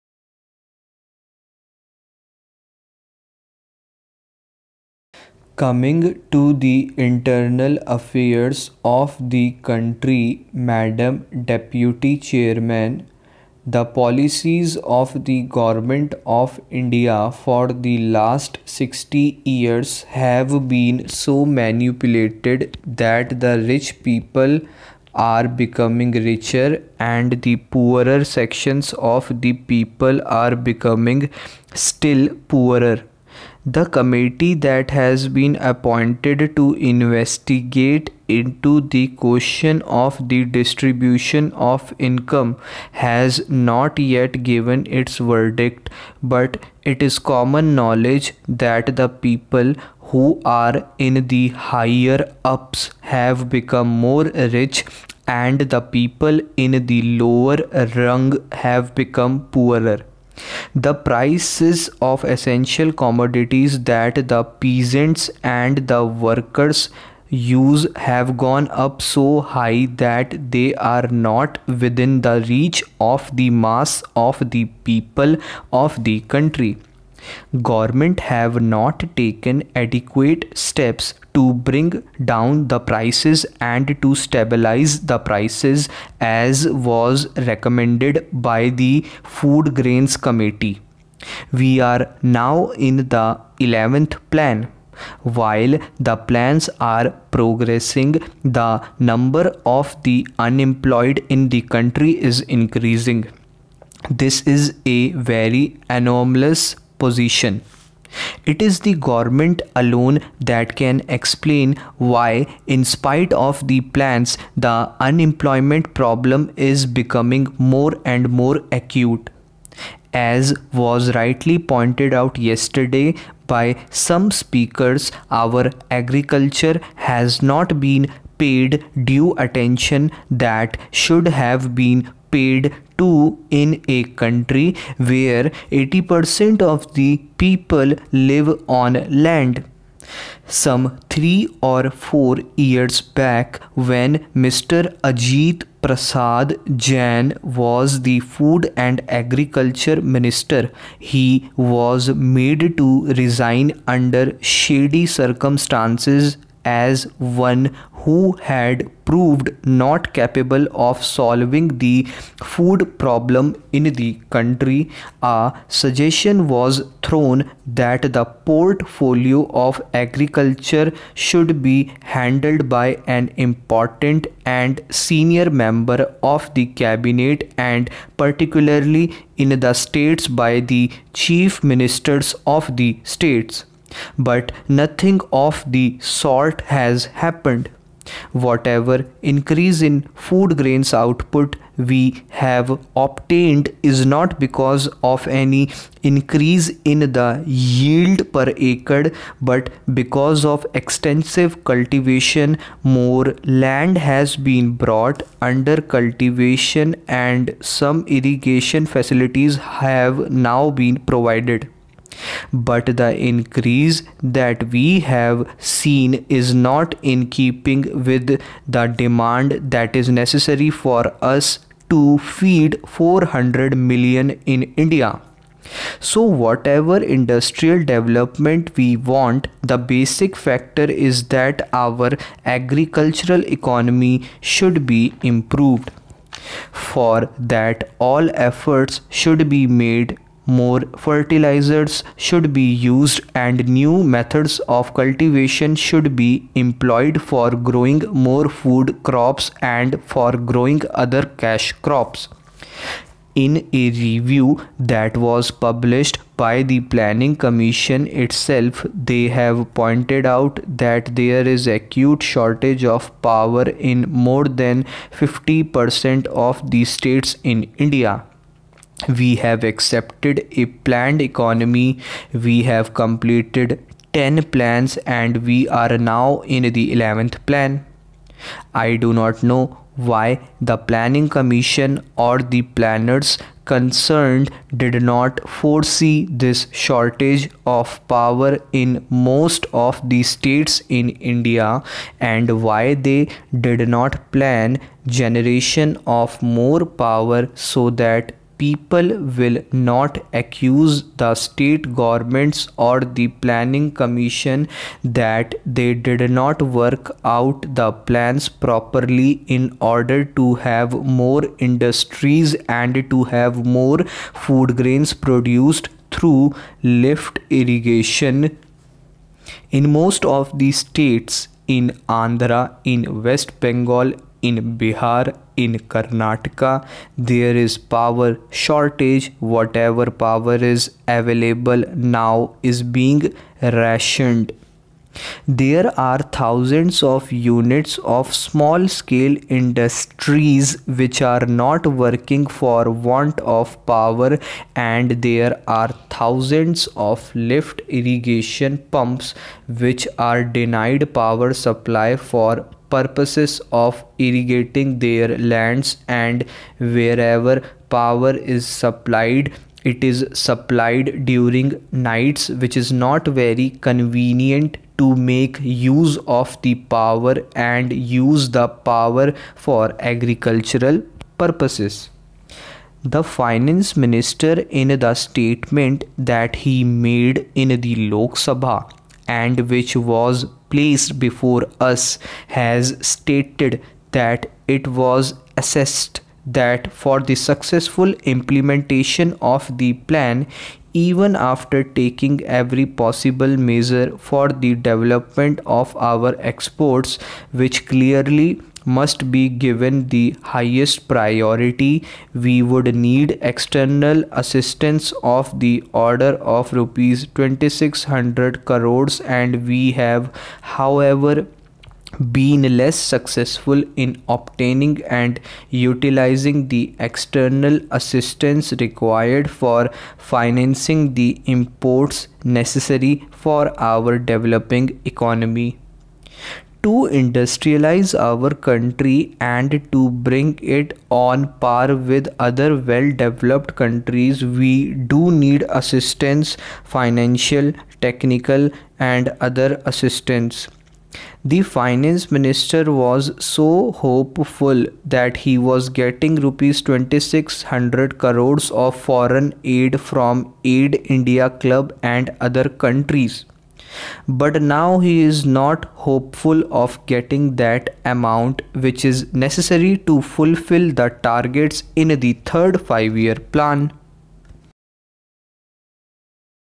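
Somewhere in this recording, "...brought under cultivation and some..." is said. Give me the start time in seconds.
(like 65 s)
204 s.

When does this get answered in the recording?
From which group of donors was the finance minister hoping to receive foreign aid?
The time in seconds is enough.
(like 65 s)
450 s.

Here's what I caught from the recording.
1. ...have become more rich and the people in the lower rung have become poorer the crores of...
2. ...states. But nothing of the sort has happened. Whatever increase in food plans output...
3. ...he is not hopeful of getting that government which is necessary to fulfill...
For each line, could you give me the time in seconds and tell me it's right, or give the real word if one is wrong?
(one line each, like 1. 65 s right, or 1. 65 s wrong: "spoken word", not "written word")
1. 53 s wrong: "prices", not "crores"
2. 183 s wrong: "grains", not "plans"
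3. 454 s wrong: "amount", not "government".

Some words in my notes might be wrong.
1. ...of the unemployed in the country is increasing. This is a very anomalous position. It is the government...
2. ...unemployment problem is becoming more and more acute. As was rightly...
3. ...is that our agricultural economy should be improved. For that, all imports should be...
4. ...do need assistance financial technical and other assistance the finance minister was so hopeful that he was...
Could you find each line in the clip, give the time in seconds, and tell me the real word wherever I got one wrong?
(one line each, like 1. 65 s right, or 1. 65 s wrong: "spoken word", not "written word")
1. 99 s right
2. 114 s right
3. 230 s wrong: "efforts", not "imports"
4. 435 s right.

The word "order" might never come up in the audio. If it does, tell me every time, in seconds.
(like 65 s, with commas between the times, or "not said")
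309 s, 405 s.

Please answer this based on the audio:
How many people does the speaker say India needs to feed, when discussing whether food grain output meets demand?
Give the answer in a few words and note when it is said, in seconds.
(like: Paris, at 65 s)
400 million, at 222 s.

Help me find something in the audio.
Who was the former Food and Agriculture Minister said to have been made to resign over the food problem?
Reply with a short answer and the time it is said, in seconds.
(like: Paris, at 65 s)
Ajit Prasad Jain, at 145 s.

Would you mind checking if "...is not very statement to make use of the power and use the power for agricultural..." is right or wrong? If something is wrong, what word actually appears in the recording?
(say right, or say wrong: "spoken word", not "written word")
wrong: "convenient", not "statement".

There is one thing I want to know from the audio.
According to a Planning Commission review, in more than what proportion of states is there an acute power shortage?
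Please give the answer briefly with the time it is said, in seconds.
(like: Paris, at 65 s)
50%, at 265 s.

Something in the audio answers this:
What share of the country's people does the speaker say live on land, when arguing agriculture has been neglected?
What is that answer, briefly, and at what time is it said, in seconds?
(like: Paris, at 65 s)
80%, at 135 s.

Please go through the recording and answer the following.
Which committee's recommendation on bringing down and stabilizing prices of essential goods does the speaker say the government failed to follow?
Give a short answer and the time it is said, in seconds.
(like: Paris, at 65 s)
Food Grains Committee, at 89 s.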